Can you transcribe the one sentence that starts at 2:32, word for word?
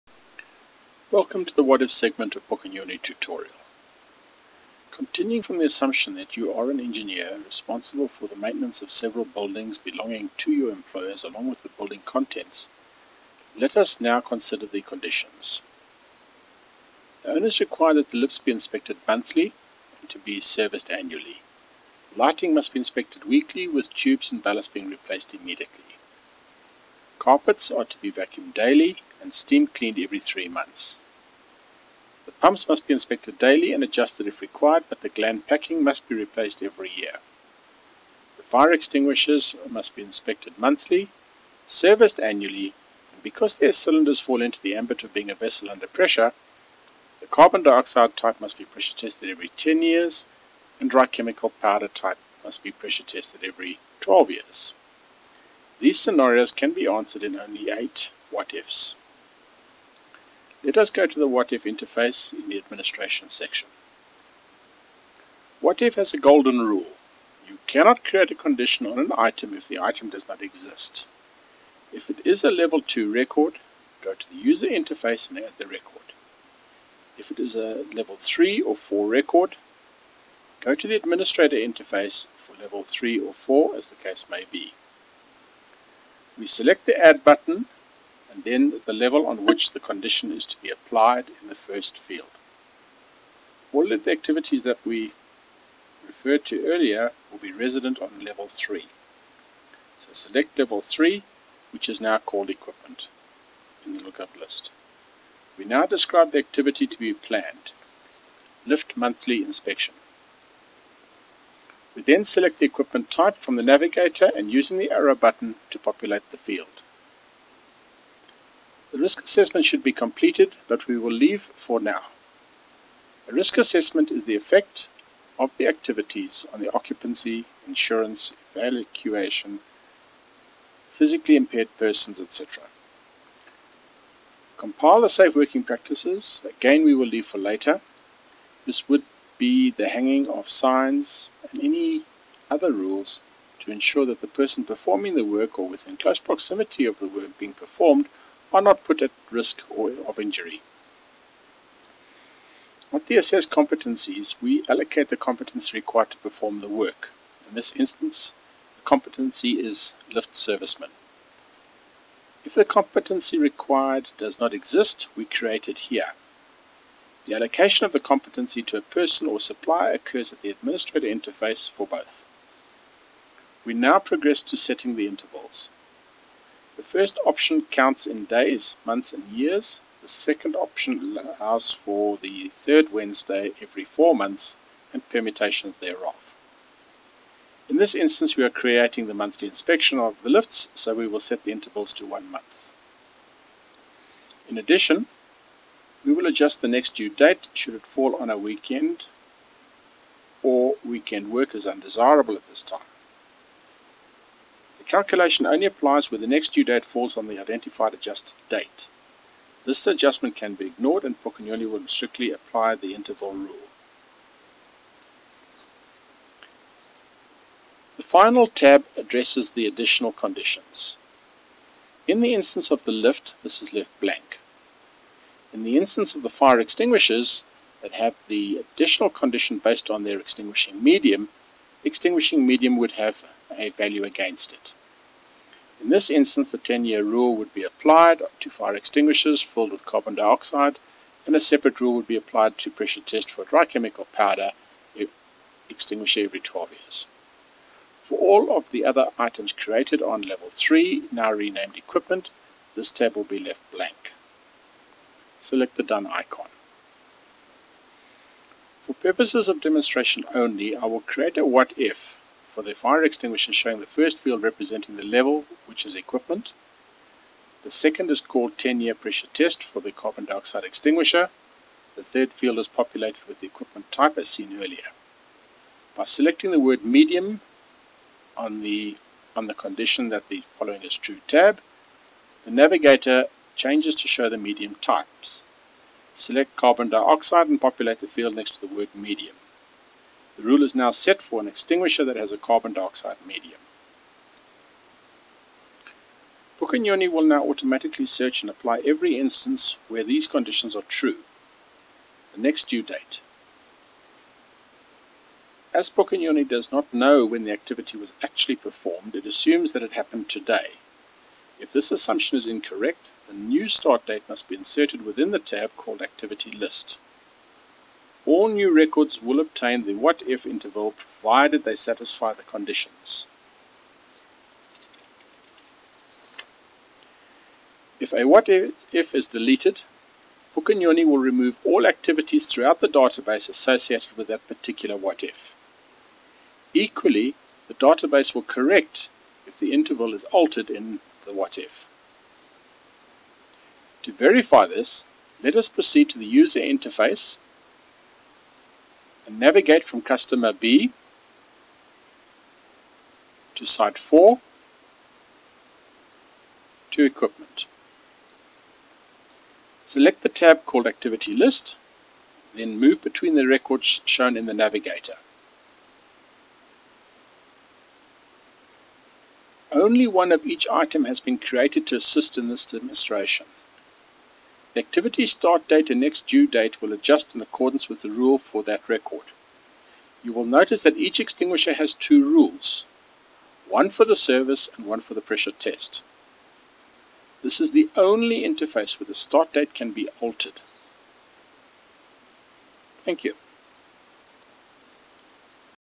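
With the assessed competencies, we allocate the competency required to perform the work.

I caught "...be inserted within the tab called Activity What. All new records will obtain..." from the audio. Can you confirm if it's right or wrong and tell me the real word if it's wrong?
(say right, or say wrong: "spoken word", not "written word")
wrong: "List", not "What".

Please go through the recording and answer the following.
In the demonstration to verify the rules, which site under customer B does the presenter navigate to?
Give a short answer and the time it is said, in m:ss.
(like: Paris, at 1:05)
site 4, at 5:53.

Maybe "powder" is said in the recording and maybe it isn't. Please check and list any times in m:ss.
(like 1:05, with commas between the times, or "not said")
0:51, 4:04.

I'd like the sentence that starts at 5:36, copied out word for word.
Equally, the database will correct if the interval is altered in the what-if.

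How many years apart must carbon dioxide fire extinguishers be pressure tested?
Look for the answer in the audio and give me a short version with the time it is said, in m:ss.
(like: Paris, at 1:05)
10, at 0:49.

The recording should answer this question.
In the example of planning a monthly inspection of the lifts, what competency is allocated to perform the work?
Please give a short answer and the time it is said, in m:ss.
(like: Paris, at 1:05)
lift serviceman, at 2:40.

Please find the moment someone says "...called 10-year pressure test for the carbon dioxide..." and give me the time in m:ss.
4:28.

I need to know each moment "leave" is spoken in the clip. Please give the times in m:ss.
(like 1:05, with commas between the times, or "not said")
2:01, 2:17.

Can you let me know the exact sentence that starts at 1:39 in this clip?
So select level 3, which is now called equipment in the lookup list.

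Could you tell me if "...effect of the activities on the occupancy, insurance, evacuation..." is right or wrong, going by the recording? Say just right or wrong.
right.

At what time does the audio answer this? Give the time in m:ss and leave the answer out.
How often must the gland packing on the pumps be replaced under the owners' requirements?
0:36.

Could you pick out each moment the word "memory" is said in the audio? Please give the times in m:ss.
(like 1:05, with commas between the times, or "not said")
not said.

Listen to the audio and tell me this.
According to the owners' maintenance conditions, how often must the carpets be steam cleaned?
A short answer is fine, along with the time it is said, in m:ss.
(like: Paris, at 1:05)
every 3 months, at 0:29.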